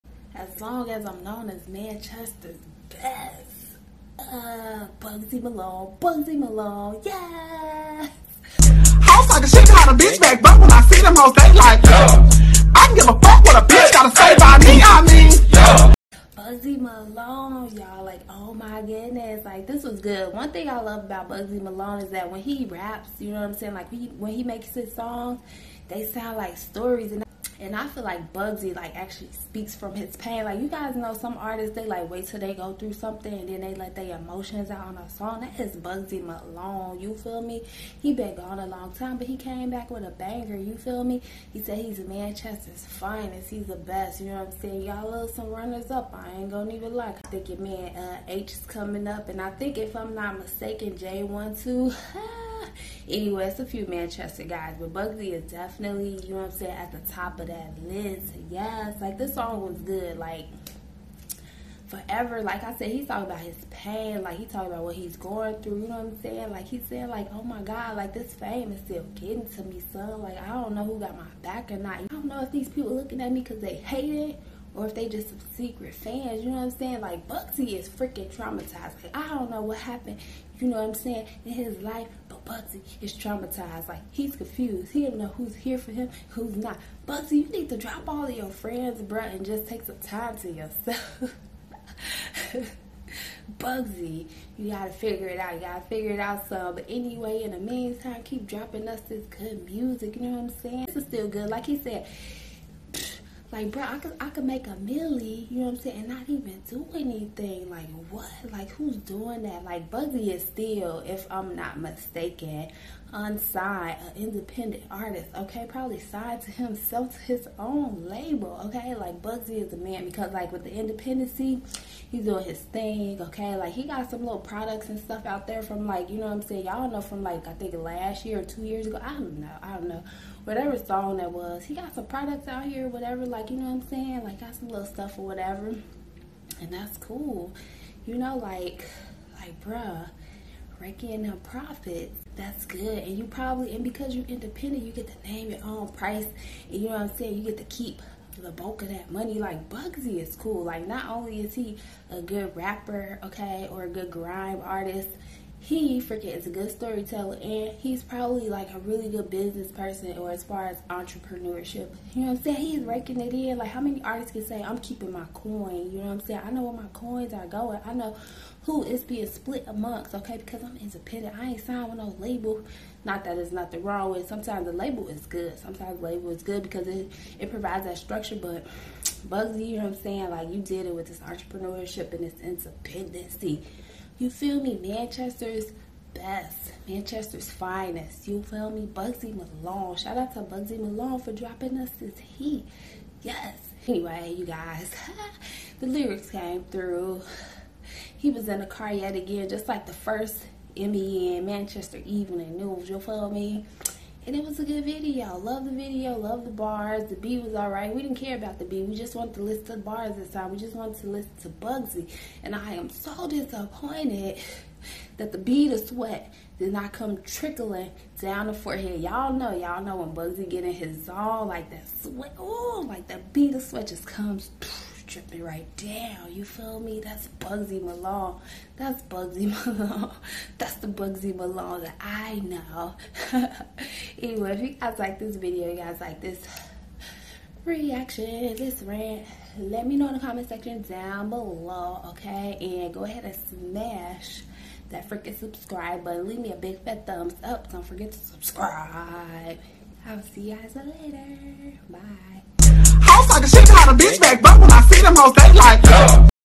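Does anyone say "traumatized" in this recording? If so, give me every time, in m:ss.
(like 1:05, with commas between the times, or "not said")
1:18, 1:23.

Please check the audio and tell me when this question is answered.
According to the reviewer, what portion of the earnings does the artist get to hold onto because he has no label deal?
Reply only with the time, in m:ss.
2:28.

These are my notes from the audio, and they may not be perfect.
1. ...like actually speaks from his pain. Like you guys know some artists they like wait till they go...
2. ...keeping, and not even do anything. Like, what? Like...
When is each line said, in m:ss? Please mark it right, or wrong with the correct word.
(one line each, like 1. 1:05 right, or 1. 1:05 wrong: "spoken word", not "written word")
1. 0:28 right
2. 1:45 wrong: "saying", not "keeping".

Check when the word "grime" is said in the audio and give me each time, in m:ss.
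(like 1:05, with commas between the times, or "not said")
2:34.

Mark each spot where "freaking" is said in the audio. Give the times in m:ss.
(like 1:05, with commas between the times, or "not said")
1:17, 2:36, 4:05.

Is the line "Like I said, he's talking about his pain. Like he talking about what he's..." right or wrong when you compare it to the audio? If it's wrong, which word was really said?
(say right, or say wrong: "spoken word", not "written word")
right.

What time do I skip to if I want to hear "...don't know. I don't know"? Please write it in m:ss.
2:09.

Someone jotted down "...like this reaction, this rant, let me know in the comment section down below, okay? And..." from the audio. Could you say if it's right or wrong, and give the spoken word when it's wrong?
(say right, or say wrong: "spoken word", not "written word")
right.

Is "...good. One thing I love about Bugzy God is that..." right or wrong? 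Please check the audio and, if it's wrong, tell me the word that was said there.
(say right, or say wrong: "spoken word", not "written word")
wrong: "Malone", not "God".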